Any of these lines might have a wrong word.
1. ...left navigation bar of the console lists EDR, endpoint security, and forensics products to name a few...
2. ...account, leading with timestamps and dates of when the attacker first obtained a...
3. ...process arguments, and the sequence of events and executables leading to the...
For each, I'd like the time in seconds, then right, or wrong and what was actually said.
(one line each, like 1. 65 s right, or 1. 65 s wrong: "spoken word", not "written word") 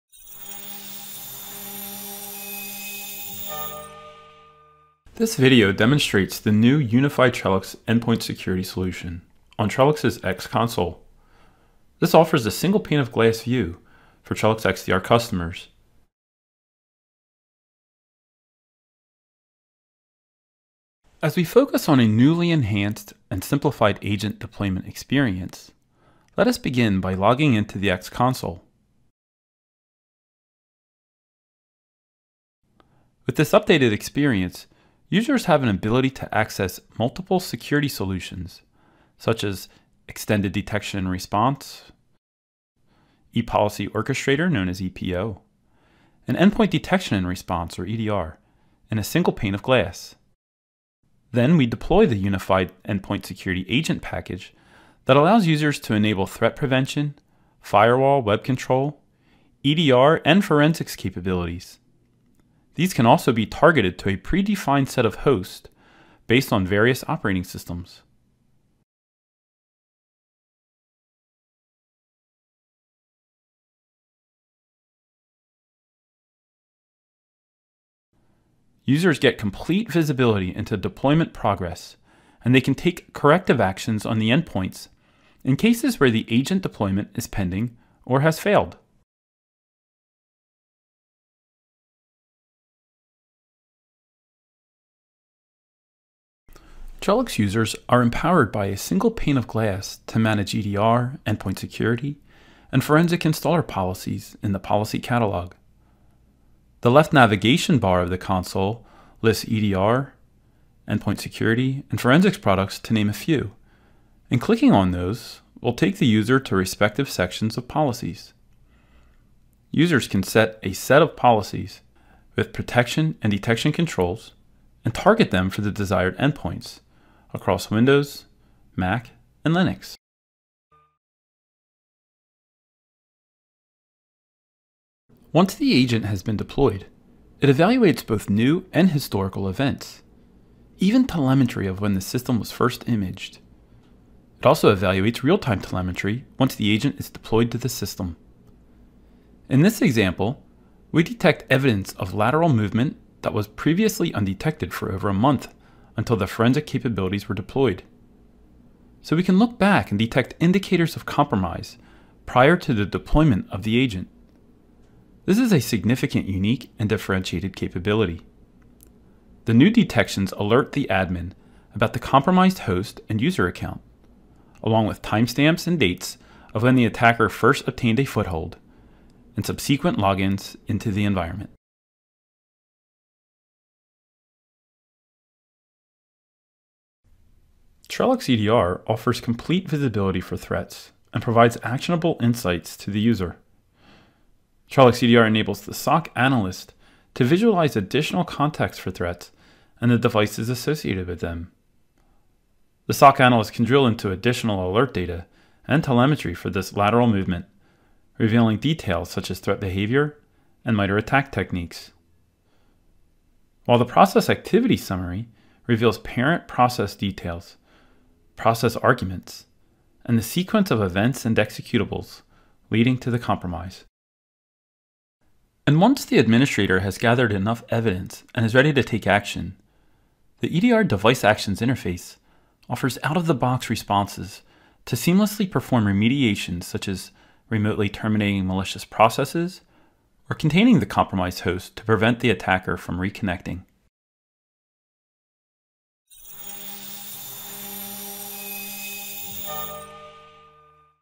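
1. 106 s right
2. 173 s wrong: "along", not "leading"
3. 218 s right.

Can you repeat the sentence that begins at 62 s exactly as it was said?
These can also be targeted to a predefined set of hosts based on various operating systems.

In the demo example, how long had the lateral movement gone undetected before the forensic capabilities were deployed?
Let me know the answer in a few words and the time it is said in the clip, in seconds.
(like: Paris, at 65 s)
over a month, at 154 s.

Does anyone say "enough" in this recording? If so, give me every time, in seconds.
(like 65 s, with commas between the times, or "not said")
227 s.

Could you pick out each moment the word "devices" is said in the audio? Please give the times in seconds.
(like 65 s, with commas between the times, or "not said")
199 s, 230 s.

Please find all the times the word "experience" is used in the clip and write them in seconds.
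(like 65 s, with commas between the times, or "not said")
24 s, 33 s.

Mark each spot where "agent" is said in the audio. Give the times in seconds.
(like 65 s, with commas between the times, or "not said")
24 s, 53 s, 86 s, 135 s, 146 s, 163 s.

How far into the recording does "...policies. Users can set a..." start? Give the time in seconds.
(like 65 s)
117 s.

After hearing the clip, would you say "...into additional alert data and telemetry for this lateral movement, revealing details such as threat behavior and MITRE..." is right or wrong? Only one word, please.
right.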